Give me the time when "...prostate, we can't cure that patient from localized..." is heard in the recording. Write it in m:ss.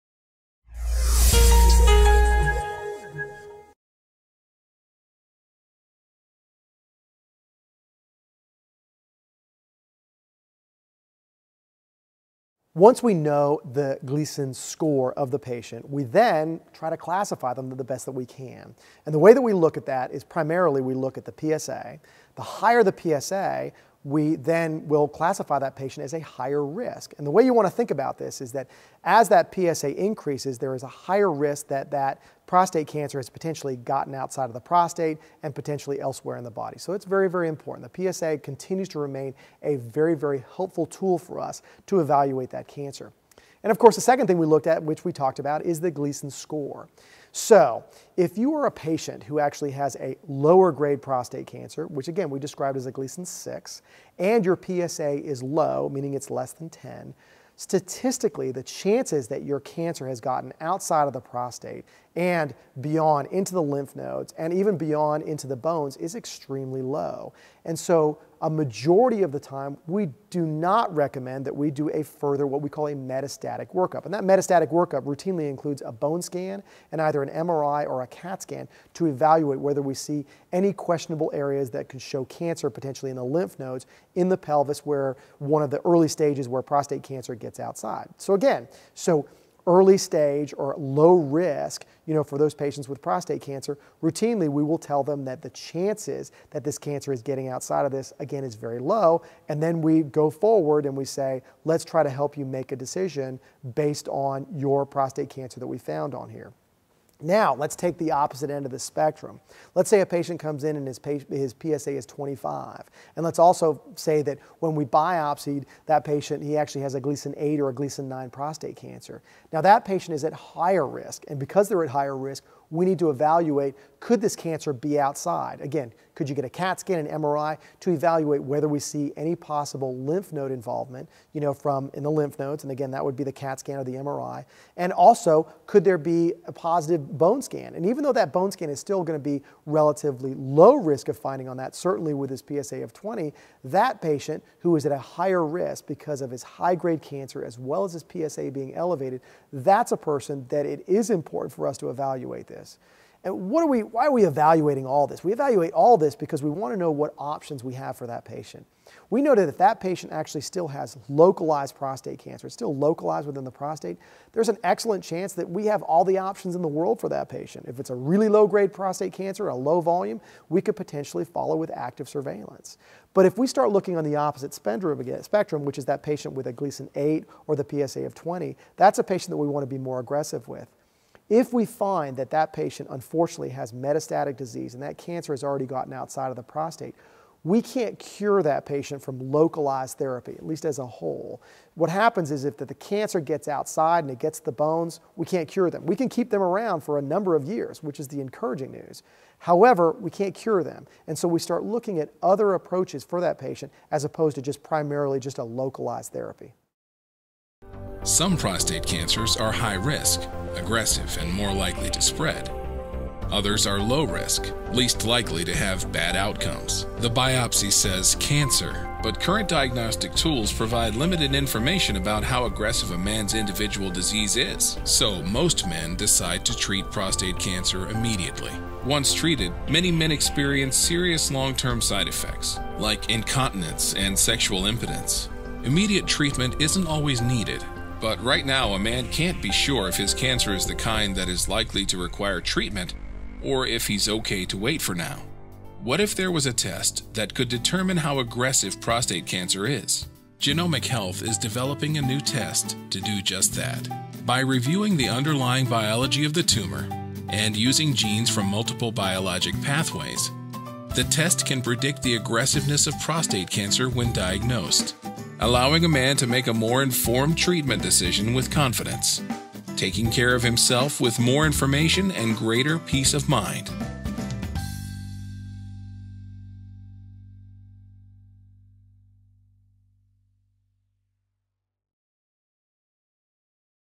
3:06.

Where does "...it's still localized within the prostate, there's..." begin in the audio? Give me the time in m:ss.
2:42.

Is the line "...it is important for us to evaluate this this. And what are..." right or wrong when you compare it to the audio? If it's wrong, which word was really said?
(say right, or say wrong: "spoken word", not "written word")
right.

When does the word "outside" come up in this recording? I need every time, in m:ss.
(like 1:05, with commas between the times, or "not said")
0:34, 1:00, 1:27, 1:37, 2:04, 3:05, 3:13.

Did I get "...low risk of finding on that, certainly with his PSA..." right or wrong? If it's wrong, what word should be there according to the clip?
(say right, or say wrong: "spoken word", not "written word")
right.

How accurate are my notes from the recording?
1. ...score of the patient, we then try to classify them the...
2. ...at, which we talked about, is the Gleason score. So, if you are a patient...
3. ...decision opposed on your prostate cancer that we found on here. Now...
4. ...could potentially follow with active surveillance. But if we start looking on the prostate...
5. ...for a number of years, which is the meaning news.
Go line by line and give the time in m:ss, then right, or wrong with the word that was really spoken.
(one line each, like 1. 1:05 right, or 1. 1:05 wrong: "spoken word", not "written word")
1. 0:14 right
2. 0:44 right
3. 1:42 wrong: "based", not "opposed"
4. 2:50 wrong: "opposite", not "prostate"
5. 3:16 wrong: "encouraging", not "meaning".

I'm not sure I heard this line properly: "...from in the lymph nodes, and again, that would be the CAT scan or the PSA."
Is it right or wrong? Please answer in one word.
wrong.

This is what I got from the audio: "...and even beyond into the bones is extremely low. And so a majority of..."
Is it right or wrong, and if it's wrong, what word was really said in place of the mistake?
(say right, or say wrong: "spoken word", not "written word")
right.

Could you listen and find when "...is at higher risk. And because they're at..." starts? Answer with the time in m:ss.
2:00.